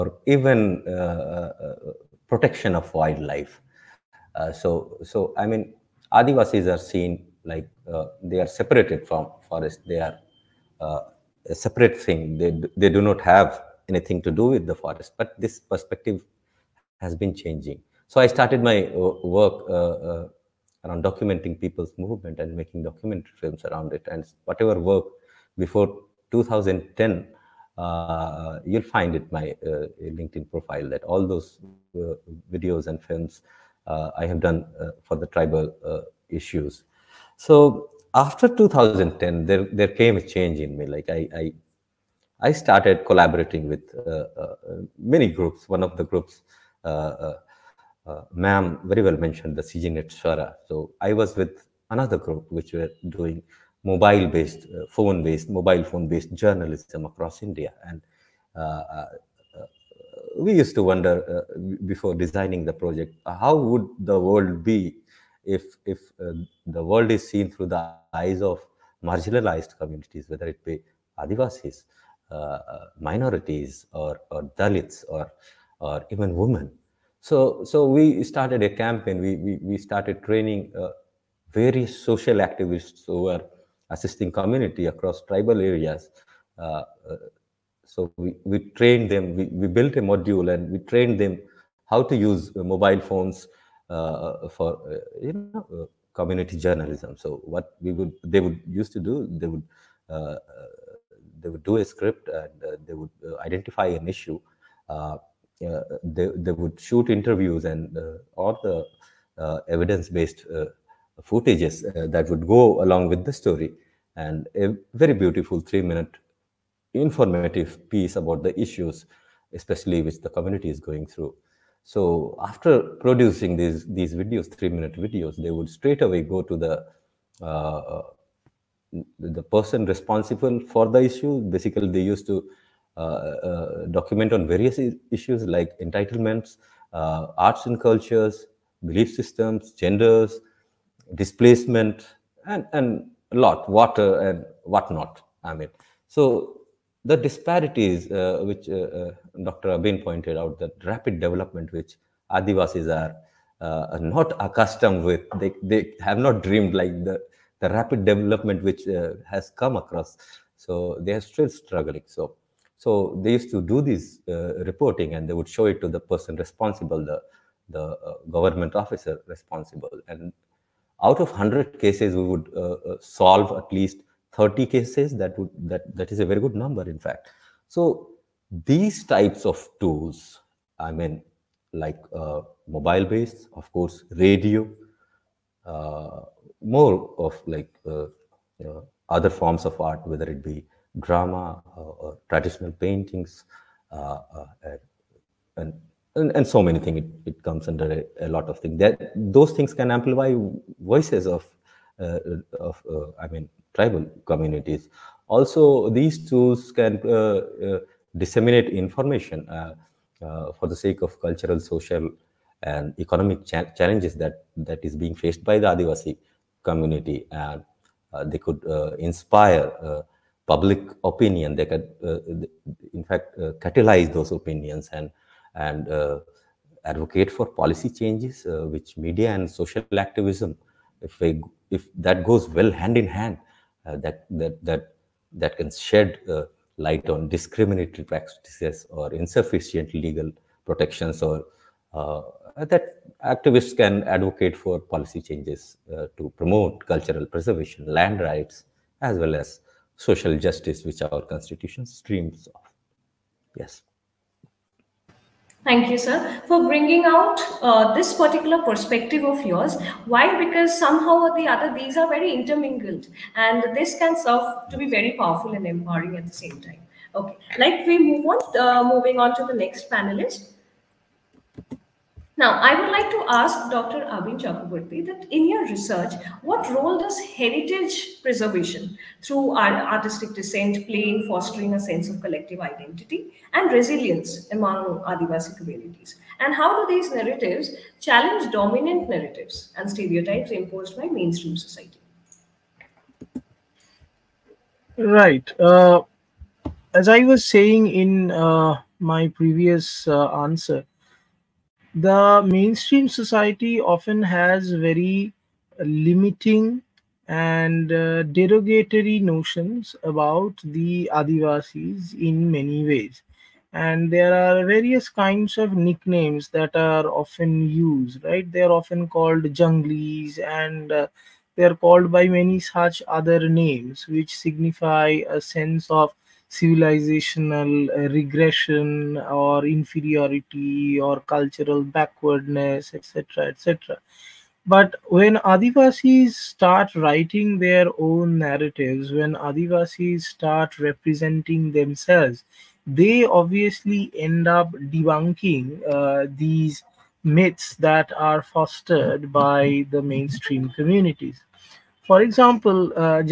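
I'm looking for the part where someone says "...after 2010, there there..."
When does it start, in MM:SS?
00:38.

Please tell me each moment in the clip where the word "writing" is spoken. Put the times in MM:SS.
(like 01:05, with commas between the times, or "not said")
05:36.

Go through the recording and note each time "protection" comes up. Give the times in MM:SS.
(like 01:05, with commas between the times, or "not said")
00:02, 04:00.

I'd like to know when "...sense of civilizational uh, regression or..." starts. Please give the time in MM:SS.
05:25.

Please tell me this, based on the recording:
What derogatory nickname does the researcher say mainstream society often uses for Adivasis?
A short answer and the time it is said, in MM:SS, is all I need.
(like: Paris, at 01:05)
junglies, at 05:19.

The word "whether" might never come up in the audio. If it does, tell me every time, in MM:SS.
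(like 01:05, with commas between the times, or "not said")
01:10, 03:10.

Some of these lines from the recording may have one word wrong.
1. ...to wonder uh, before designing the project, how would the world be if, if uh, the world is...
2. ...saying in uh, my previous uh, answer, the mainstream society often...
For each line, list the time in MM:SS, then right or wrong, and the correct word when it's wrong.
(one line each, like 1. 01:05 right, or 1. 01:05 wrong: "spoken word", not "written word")
1. 01:00 right
2. 04:57 right.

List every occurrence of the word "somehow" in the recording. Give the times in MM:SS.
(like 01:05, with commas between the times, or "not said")
04:20.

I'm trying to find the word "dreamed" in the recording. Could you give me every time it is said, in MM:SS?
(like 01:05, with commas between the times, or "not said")
02:36.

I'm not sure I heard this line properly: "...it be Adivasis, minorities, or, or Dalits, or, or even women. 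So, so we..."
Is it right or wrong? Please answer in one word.
right.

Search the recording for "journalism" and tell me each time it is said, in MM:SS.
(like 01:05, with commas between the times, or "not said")
00:56, 01:36.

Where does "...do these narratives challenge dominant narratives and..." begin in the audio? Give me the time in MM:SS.
04:46.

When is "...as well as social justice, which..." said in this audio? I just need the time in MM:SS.
04:09.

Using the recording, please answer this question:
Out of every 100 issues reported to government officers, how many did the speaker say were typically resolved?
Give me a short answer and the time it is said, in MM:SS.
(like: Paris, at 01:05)
30, at 02:54.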